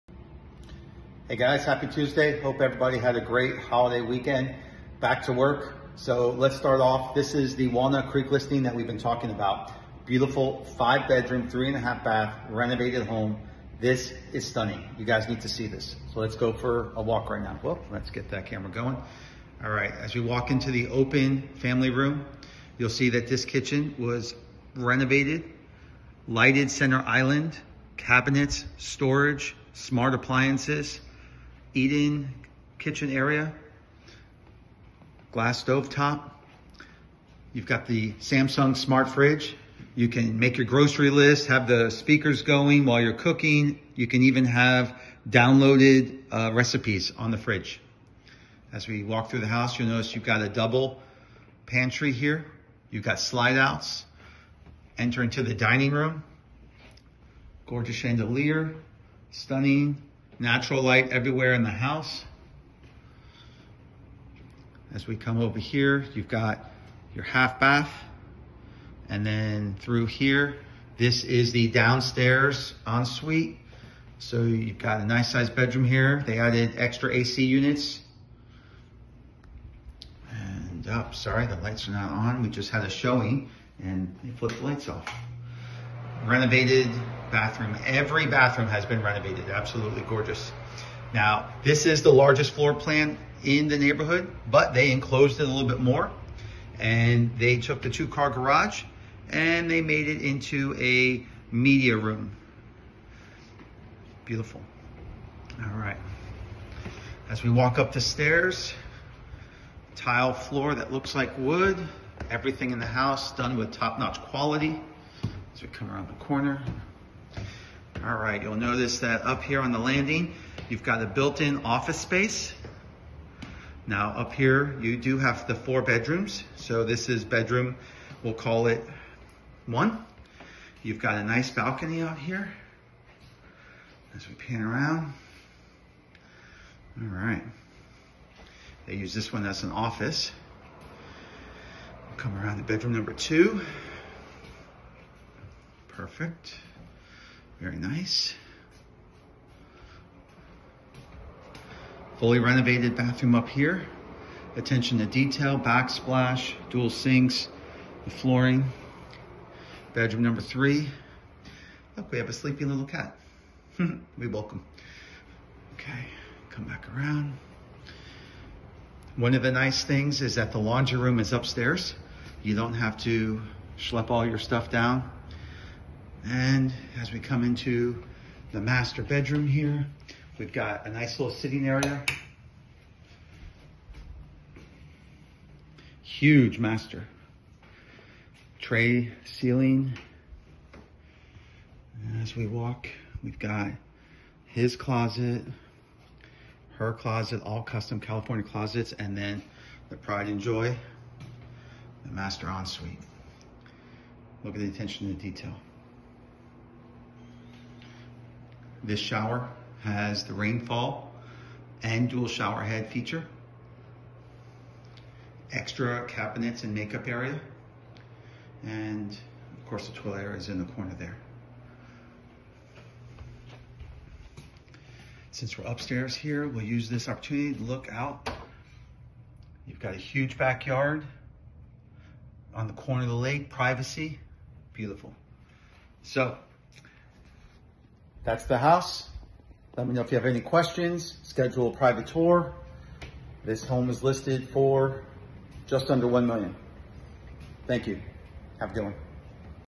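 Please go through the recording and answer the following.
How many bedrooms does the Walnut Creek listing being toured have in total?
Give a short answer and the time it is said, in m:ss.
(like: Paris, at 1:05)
5, at 0:10.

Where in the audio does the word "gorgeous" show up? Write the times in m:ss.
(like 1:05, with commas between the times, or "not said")
0:57, 1:30.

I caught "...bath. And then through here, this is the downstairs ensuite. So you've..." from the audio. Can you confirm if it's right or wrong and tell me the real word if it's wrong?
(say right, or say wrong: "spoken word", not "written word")
right.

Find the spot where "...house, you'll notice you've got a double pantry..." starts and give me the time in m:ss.
0:49.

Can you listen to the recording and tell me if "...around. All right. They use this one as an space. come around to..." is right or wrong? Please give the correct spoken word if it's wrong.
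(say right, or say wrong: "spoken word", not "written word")
wrong: "office", not "space".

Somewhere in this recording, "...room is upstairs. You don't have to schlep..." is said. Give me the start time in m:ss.
2:50.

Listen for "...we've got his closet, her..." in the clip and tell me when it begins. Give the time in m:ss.
3:13.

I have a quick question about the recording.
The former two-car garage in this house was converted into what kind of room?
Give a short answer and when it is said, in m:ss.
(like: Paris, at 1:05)
media room, at 1:41.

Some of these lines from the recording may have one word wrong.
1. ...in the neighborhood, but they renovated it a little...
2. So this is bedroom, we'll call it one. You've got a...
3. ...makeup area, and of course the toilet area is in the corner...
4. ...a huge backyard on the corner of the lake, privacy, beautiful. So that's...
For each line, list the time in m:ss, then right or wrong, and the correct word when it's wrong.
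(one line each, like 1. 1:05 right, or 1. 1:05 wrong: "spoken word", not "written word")
1. 1:33 wrong: "enclosed", not "renovated"
2. 2:06 right
3. 3:36 right
4. 3:49 right.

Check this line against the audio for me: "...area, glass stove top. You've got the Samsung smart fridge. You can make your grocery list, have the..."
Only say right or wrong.
right.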